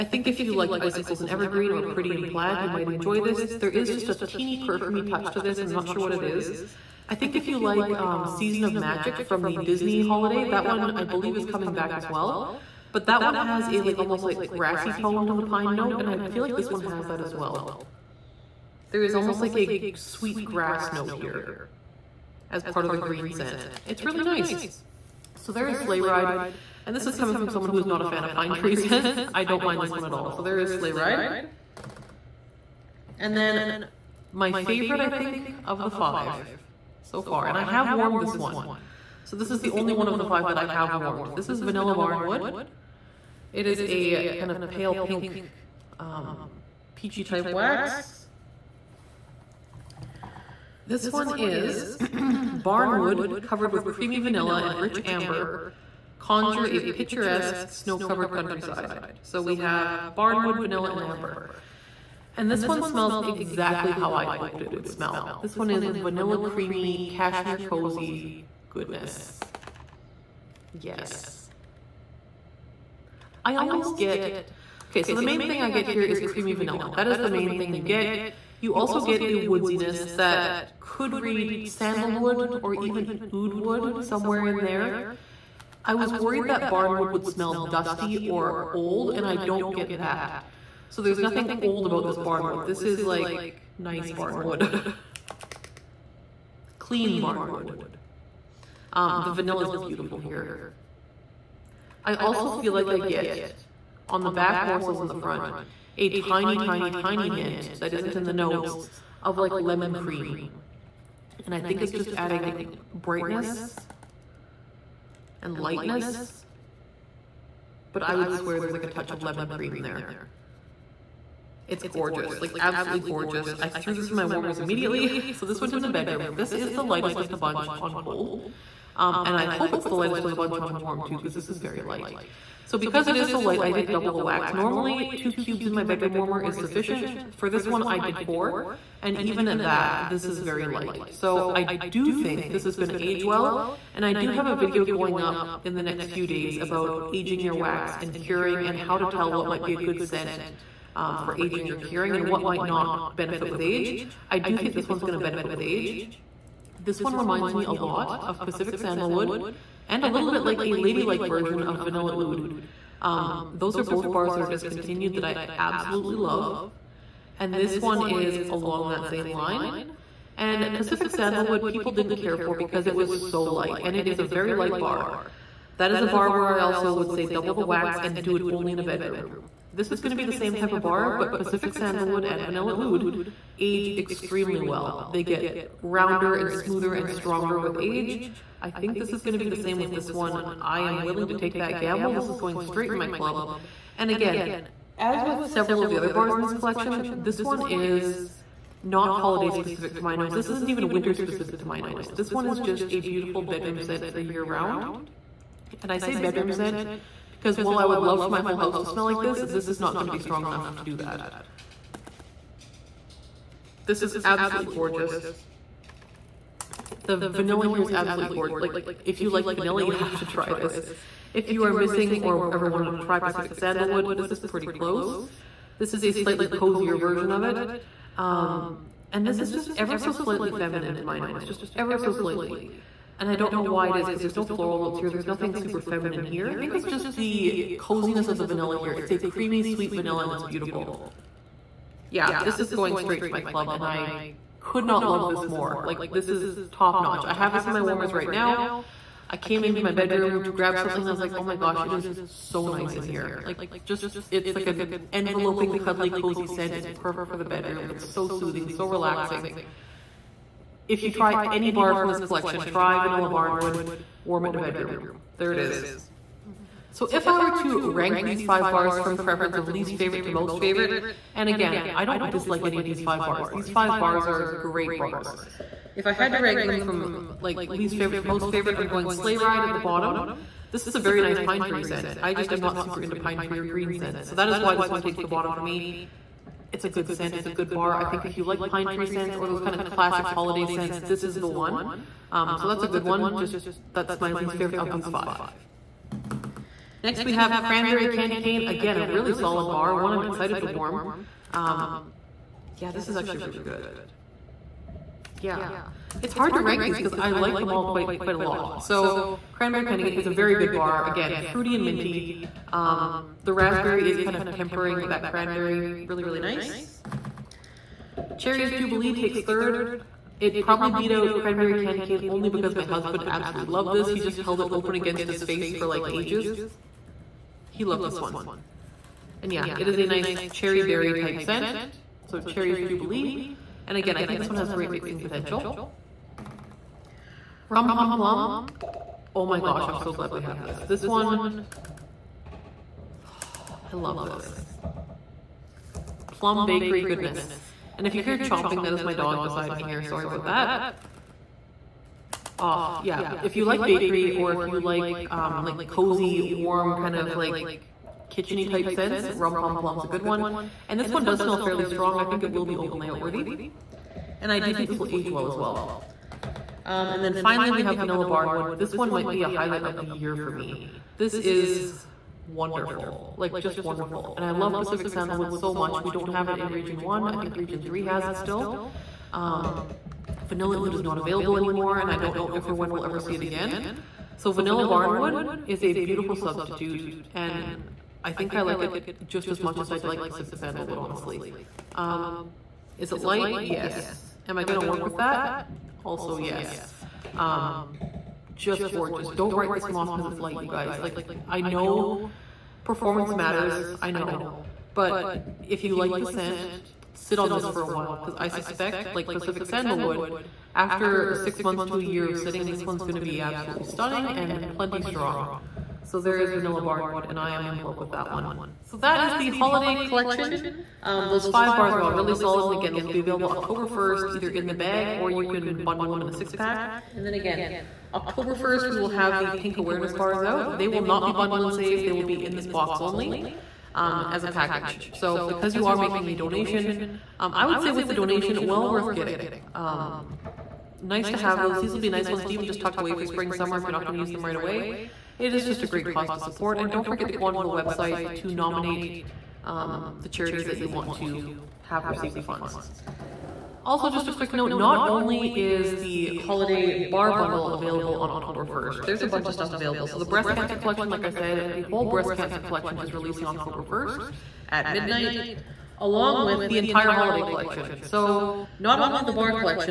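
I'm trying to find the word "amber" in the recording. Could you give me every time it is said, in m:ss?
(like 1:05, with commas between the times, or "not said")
0:55, 1:01.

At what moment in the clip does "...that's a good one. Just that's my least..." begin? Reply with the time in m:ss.
4:52.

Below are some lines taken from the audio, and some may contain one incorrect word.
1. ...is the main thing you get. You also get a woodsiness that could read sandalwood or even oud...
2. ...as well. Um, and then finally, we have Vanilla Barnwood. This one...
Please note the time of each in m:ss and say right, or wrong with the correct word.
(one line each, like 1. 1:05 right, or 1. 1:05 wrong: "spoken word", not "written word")
1. 1:17 right
2. 6:05 right.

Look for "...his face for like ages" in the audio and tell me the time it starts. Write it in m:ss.
5:25.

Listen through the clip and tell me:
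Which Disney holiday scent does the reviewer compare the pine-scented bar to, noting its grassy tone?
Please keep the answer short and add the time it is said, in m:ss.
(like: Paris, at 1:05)
Season of Magic, at 0:08.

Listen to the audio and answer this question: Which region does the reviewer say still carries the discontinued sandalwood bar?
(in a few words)
region 3.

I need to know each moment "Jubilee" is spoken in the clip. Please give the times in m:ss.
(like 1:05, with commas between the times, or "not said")
5:18, 5:32.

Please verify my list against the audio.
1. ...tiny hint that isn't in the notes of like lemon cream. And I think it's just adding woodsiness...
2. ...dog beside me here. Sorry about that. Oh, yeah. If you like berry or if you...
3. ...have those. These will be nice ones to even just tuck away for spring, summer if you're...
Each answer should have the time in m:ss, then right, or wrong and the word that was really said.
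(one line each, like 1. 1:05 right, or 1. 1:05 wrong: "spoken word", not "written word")
1. 1:46 wrong: "brightness", not "woodsiness"
2. 5:49 wrong: "bakery", not "berry"
3. 7:21 right.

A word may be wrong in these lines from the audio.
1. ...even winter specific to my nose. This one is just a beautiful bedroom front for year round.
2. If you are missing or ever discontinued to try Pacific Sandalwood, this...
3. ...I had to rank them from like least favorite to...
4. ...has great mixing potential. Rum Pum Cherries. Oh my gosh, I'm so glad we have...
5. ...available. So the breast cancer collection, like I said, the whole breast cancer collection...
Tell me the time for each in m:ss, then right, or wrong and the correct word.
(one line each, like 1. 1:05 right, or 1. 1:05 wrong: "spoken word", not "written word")
1. 3:20 wrong: "scent", not "front"
2. 3:41 wrong: "wanted", not "discontinued"
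3. 4:36 right
4. 5:34 wrong: "Plum", not "Cherries"
5. 7:39 right.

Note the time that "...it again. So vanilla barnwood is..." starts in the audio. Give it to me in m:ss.
6:23.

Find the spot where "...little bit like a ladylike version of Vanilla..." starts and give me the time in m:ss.
2:40.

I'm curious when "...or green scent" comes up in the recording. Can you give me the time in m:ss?
4:43.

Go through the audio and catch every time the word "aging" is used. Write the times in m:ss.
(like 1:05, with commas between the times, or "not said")
2:27, 2:31.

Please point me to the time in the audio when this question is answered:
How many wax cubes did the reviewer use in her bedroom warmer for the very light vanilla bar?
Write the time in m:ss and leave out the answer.
2:18.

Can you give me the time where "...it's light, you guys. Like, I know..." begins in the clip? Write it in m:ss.
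6:40.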